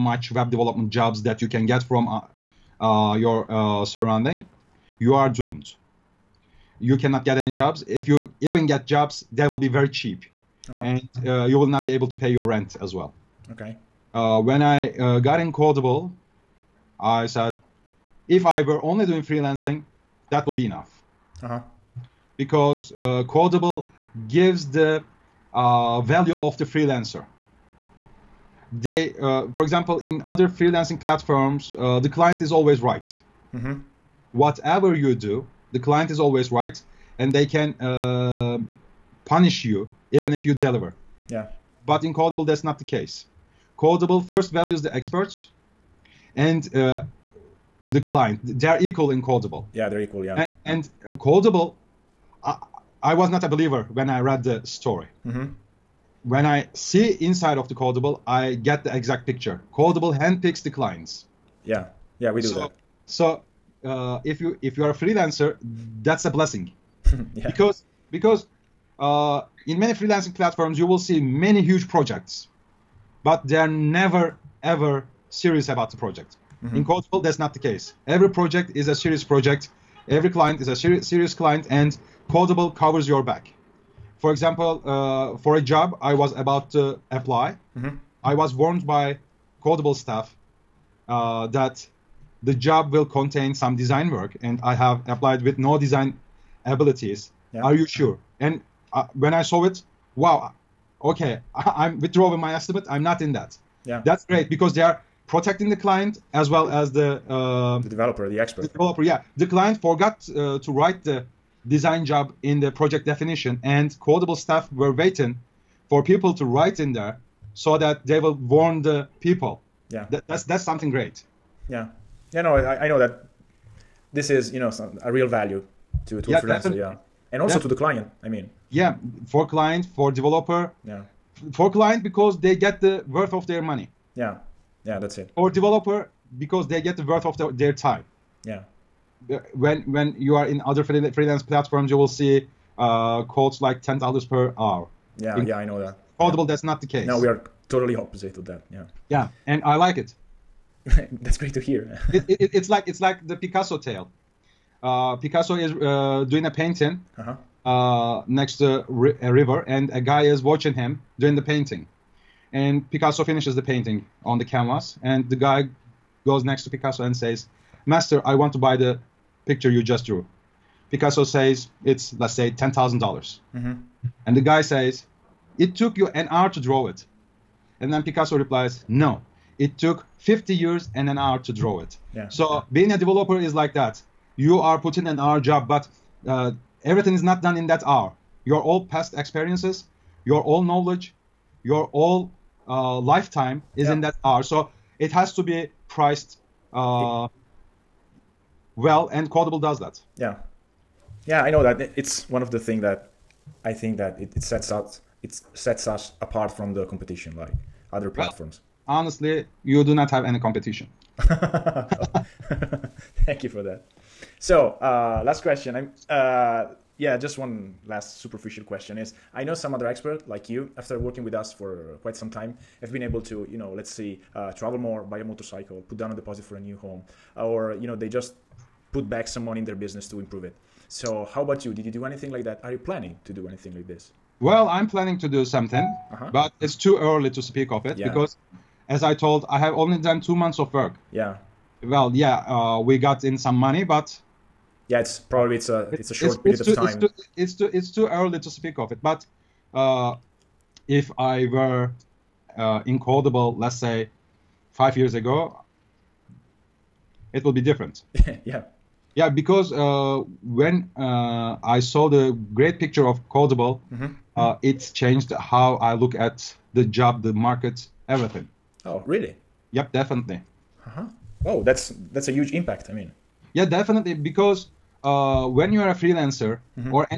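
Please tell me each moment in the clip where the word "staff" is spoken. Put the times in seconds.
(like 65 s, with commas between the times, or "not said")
89 s, 114 s.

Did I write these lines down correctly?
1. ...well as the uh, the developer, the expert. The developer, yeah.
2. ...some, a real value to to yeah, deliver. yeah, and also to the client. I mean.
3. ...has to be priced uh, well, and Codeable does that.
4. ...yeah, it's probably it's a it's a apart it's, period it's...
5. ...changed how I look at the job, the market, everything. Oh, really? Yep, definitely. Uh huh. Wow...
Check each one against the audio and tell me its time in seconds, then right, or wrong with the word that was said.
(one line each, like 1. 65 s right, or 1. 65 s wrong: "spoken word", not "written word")
1. 106 s right
2. 124 s wrong: "freelancer", not "deliver"
3. 195 s right
4. 244 s wrong: "short", not "apart"
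5. 264 s right.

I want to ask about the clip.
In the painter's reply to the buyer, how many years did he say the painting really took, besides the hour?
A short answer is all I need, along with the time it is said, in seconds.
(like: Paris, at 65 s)
50, at 180 s.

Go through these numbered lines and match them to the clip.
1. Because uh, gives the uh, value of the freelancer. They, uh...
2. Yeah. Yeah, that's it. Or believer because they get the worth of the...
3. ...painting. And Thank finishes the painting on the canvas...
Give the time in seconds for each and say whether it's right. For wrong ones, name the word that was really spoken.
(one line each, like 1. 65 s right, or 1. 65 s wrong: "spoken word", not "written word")
1. 22 s right
2. 134 s wrong: "developer", not "believer"
3. 161 s wrong: "Picasso", not "Thank".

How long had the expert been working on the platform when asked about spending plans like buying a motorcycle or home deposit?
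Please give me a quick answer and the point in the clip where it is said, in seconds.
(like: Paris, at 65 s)
2 months, at 240 s.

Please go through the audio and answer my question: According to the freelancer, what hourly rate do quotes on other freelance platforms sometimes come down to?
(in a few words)
$10 per hour.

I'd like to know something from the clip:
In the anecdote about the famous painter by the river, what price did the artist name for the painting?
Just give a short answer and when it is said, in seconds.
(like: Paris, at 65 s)
$10,000, at 172 s.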